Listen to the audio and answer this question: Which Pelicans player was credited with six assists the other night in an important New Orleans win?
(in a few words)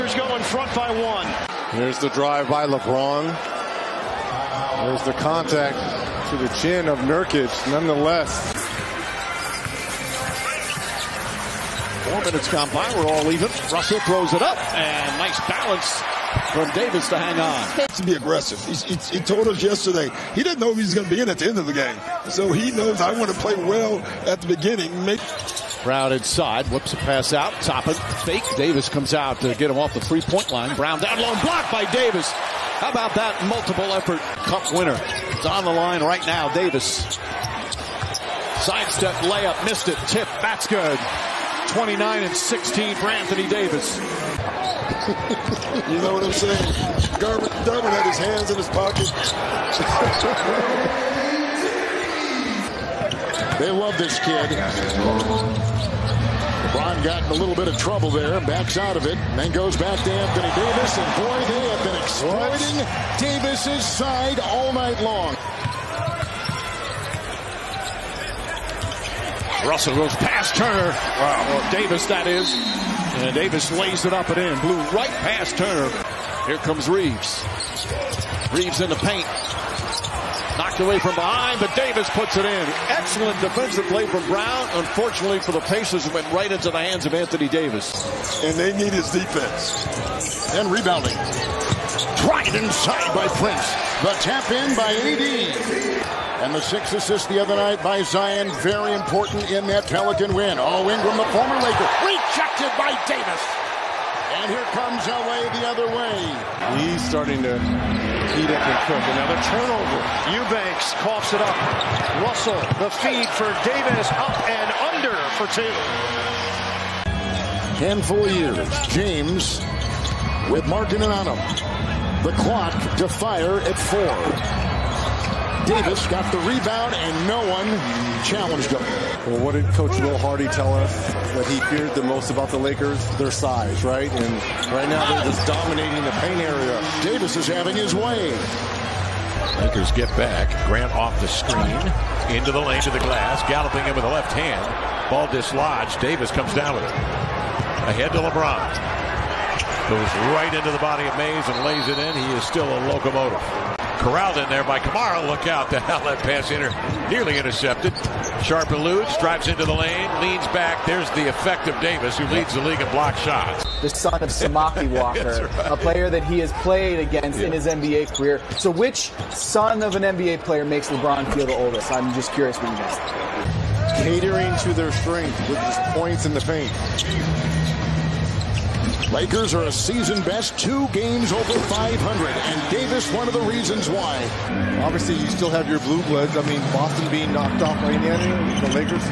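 Zion.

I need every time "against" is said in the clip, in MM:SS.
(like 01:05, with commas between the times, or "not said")
02:46.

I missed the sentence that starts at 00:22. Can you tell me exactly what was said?
So he knows I want to play well at the beginning.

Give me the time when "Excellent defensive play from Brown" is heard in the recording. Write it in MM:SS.
01:22.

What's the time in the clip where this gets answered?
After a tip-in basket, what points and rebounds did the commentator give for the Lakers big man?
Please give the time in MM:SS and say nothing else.
00:41.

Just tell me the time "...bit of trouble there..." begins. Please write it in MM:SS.
00:57.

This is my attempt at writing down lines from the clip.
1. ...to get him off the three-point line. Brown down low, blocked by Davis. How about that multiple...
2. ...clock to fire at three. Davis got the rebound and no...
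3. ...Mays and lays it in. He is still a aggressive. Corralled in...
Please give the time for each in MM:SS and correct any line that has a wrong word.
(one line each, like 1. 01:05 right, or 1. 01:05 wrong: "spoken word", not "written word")
1. 00:29 right
2. 02:02 wrong: "four", not "three"
3. 02:31 wrong: "locomotive", not "aggressive".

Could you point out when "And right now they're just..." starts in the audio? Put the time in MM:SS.
02:14.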